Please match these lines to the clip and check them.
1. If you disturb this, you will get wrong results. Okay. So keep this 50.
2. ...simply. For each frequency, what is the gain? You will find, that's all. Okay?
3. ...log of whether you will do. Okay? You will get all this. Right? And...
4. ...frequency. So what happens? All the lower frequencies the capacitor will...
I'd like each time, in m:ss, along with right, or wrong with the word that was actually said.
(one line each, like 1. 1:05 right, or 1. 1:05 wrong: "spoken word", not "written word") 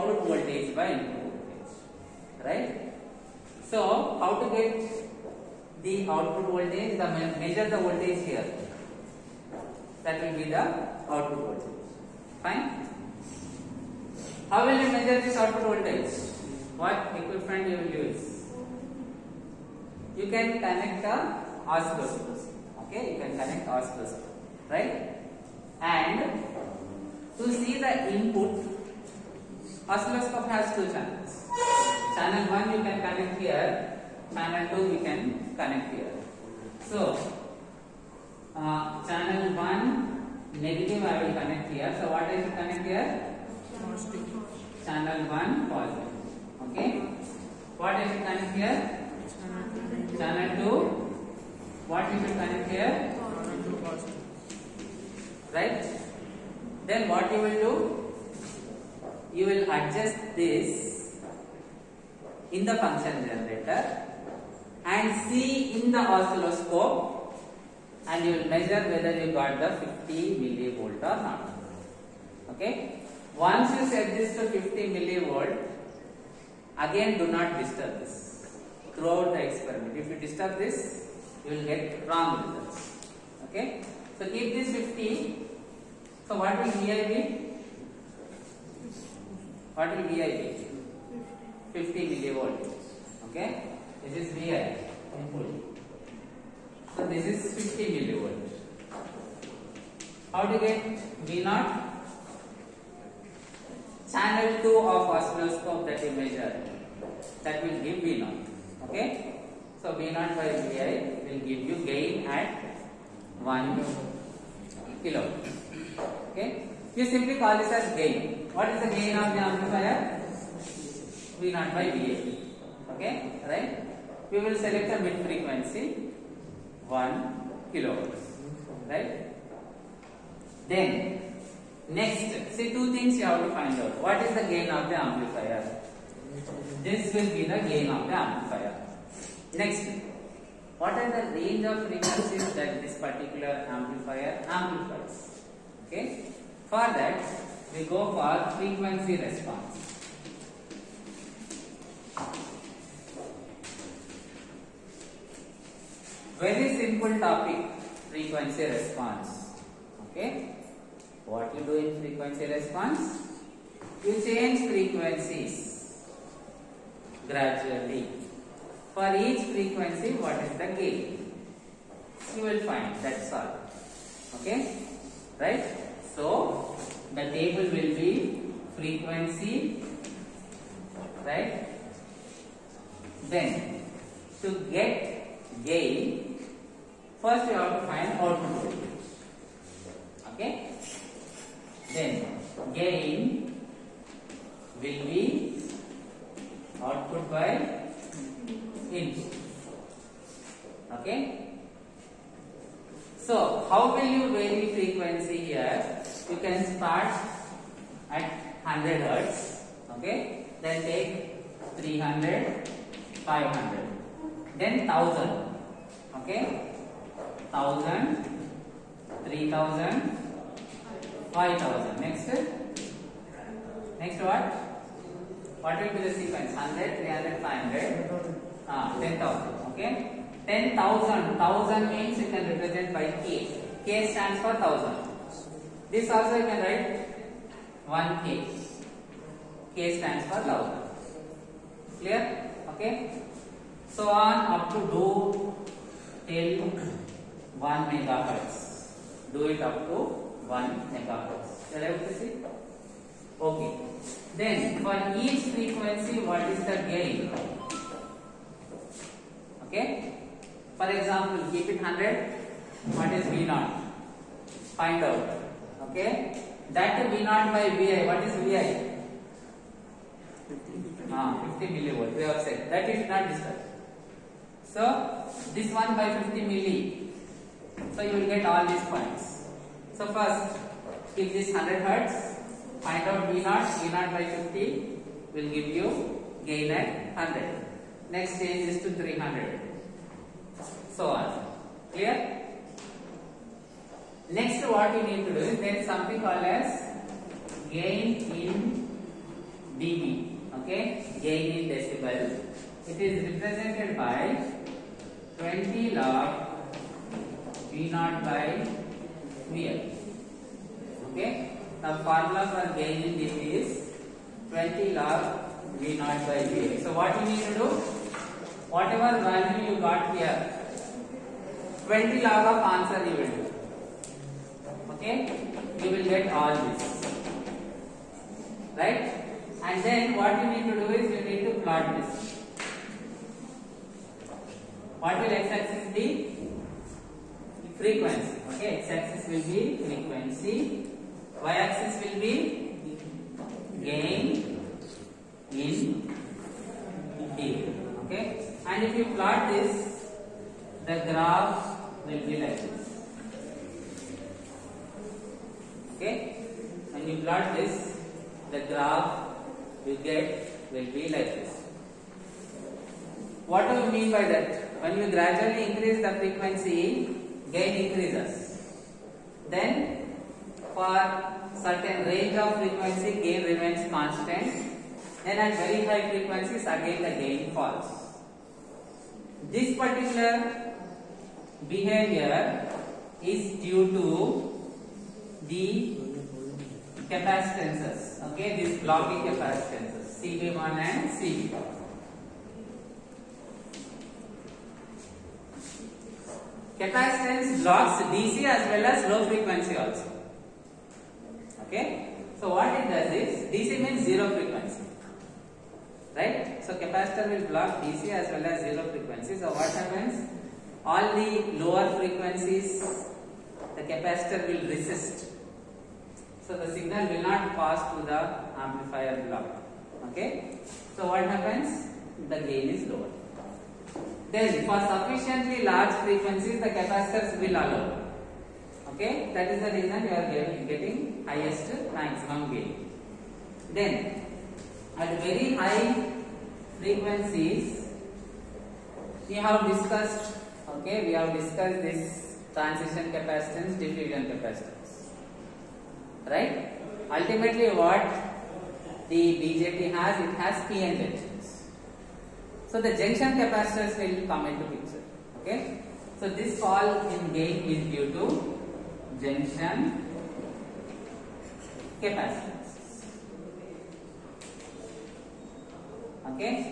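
1. 1:19 right
2. 2:47 wrong: "gradually", not "simply"
3. 5:22 wrong: "answer", not "whether"
4. 6:48 right.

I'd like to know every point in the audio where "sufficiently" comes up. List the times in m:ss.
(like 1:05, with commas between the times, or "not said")
7:04.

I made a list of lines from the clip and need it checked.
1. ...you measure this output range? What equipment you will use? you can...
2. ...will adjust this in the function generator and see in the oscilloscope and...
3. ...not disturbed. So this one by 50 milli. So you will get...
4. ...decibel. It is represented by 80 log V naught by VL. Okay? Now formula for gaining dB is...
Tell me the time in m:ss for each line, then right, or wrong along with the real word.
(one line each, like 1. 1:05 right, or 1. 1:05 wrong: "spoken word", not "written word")
1. 0:14 wrong: "voltage", not "range"
2. 0:59 right
3. 4:33 right
4. 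5:01 wrong: "20", not "80".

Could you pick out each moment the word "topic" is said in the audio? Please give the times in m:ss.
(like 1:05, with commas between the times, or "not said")
2:37.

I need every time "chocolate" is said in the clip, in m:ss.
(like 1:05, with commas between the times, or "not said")
not said.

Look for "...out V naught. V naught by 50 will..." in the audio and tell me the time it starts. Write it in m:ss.
4:43.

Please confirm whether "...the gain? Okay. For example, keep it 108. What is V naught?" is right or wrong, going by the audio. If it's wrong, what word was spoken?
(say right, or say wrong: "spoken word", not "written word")
wrong: "100", not "108".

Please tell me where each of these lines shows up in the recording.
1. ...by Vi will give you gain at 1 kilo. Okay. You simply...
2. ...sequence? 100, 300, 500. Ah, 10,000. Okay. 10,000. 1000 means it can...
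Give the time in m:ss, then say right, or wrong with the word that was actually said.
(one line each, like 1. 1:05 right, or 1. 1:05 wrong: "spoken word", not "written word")
1. 1:50 right
2. 3:46 right.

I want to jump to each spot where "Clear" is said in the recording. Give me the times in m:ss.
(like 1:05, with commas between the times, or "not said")
4:02, 4:51.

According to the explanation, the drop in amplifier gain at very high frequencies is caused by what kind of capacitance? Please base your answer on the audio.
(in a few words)
junction capacitance.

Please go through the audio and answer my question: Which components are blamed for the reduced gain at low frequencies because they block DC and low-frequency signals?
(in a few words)
blocking capacitances.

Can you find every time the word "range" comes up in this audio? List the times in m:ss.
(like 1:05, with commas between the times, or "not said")
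2:21, 6:12.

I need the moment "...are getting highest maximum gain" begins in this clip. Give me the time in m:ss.
7:10.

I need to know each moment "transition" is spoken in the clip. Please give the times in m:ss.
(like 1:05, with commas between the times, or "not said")
7:22.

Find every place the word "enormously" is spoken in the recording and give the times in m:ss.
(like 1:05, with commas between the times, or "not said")
not said.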